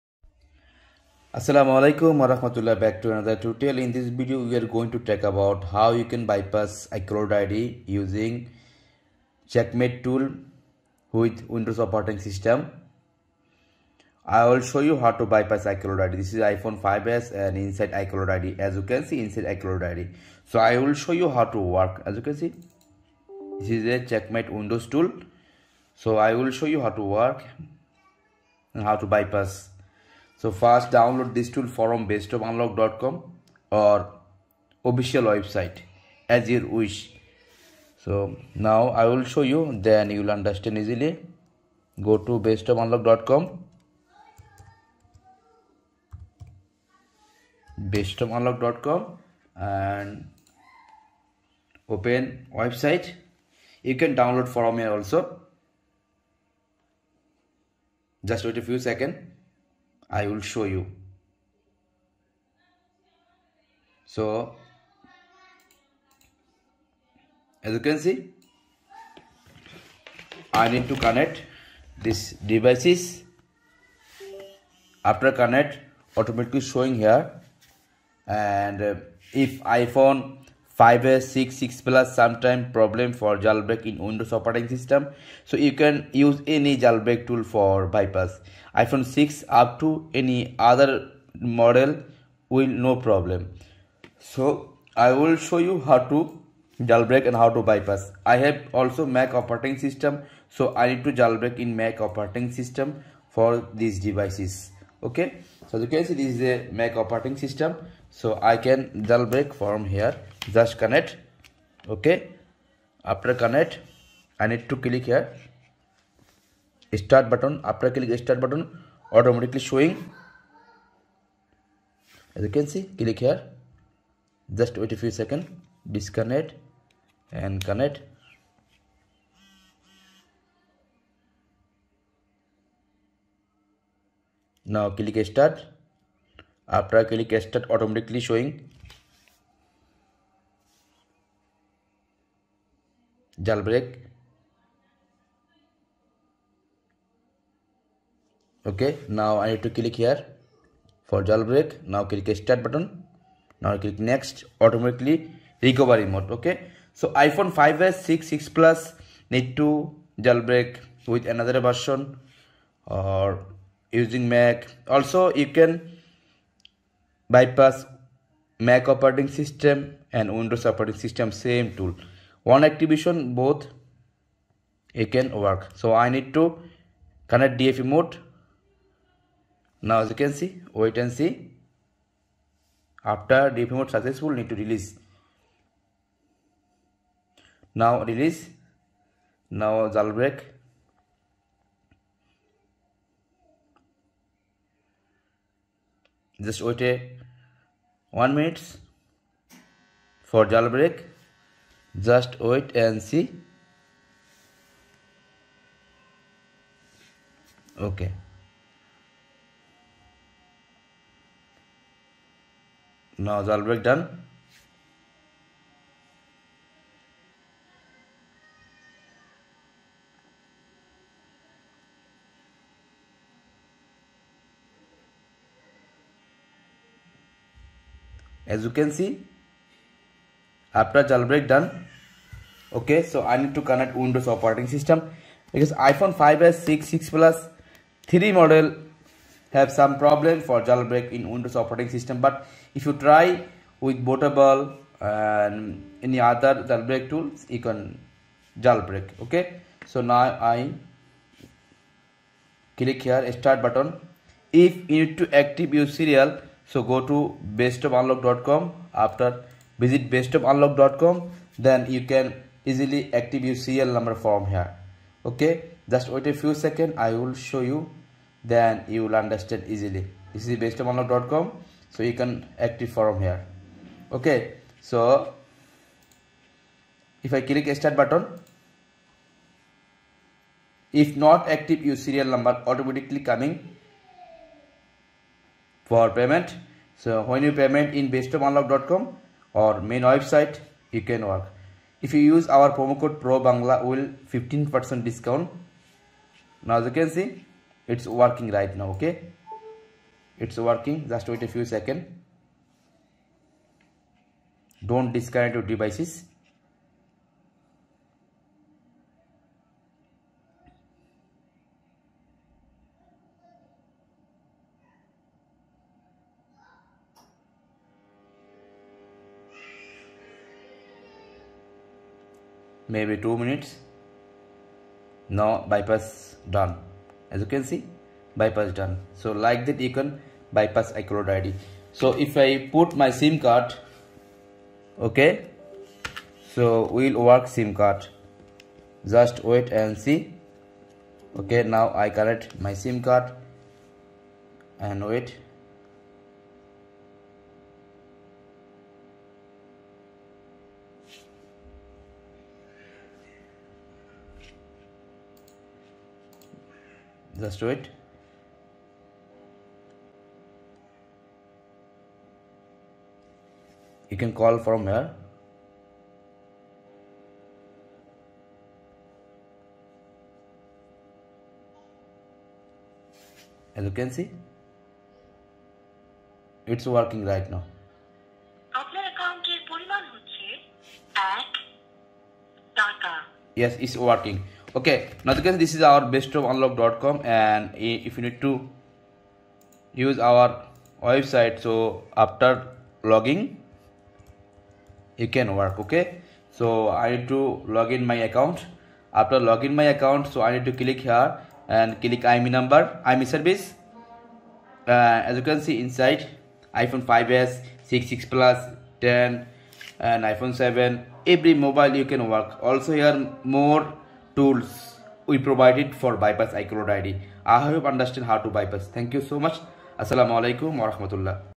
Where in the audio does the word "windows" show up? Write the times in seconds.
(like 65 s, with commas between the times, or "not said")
11 s, 24 s, 84 s, 170 s, 233 s, 241 s.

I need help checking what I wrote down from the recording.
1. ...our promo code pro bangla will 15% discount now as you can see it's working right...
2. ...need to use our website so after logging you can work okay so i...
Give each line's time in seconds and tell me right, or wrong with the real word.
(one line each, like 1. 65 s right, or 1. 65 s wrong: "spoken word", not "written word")
1. 292 s right
2. 388 s right.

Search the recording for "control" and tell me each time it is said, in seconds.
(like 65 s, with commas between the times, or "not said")
not said.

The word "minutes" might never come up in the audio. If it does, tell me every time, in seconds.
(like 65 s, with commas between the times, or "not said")
198 s, 323 s.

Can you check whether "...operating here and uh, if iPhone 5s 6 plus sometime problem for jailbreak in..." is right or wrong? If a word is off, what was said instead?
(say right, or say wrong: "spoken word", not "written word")
wrong: "showing", not "operating".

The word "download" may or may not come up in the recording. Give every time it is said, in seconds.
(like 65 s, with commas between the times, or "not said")
30 s, 54 s.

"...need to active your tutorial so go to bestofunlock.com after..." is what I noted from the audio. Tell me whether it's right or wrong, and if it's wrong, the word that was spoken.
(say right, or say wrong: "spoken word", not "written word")
wrong: "serial", not "tutorial".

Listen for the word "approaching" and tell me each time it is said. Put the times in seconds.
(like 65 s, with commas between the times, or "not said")
not said.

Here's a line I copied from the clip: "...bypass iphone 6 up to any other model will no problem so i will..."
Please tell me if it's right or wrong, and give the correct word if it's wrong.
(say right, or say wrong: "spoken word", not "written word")
right.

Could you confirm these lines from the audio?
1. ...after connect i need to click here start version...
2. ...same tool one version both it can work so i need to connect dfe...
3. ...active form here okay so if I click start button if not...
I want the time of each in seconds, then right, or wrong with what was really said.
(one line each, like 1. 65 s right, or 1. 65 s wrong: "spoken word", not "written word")
1. 113 s wrong: "button", not "version"
2. 171 s wrong: "activation", not "version"
3. 272 s right.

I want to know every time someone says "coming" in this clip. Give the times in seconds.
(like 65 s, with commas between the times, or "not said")
283 s.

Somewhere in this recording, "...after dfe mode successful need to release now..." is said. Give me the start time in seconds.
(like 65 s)
183 s.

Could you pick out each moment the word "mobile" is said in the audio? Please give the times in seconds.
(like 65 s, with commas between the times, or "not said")
411 s.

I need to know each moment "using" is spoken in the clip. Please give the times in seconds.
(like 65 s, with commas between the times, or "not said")
7 s, 164 s.